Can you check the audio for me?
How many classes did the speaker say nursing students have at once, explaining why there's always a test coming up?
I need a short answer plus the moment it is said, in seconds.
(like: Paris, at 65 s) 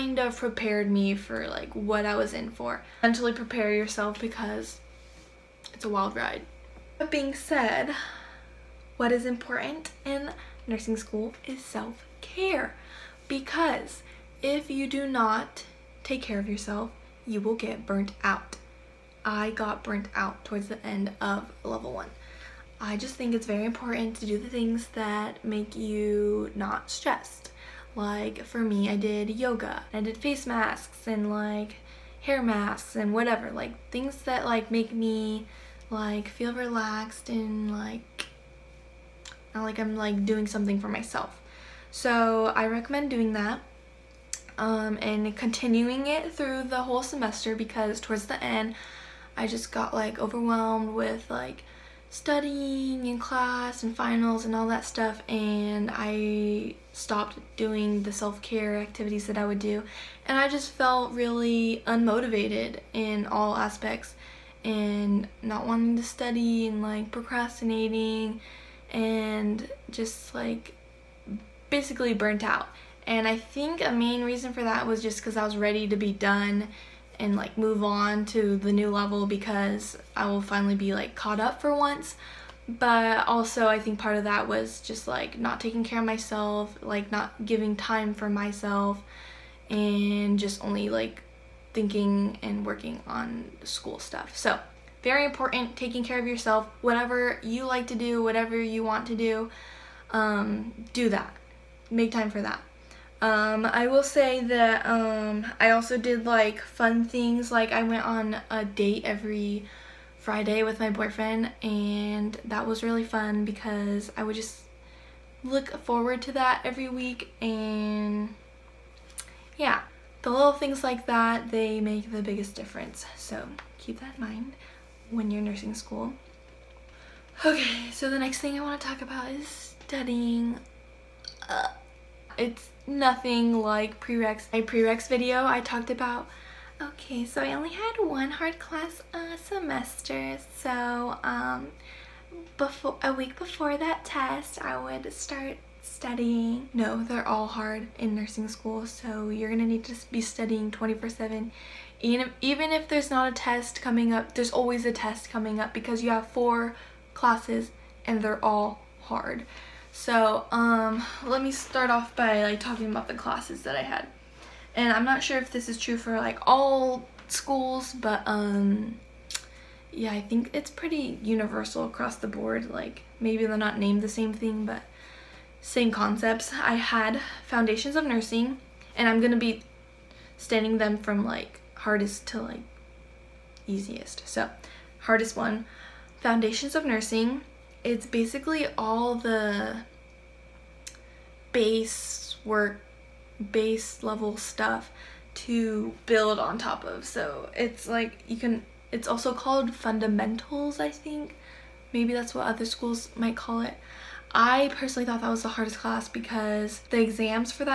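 4, at 156 s.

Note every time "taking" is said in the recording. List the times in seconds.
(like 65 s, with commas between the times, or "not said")
85 s, 95 s.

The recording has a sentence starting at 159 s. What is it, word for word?
So, um, let me start off by like talking about the classes that I had.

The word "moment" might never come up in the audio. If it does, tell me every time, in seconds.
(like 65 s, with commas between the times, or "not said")
not said.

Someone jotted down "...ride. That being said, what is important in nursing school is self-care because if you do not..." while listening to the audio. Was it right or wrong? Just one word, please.
right.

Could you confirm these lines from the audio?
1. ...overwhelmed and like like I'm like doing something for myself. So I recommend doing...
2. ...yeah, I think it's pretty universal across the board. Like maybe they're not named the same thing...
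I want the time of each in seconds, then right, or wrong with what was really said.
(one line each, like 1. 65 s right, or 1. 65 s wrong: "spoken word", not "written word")
1. 36 s wrong: "relaxed", not "overwhelmed"
2. 169 s right.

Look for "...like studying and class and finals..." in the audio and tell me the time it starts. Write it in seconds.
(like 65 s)
51 s.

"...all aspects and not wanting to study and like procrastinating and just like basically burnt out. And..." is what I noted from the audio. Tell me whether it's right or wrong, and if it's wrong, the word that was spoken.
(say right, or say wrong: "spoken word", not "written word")
right.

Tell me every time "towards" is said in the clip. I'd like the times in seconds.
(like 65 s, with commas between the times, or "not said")
20 s, 47 s.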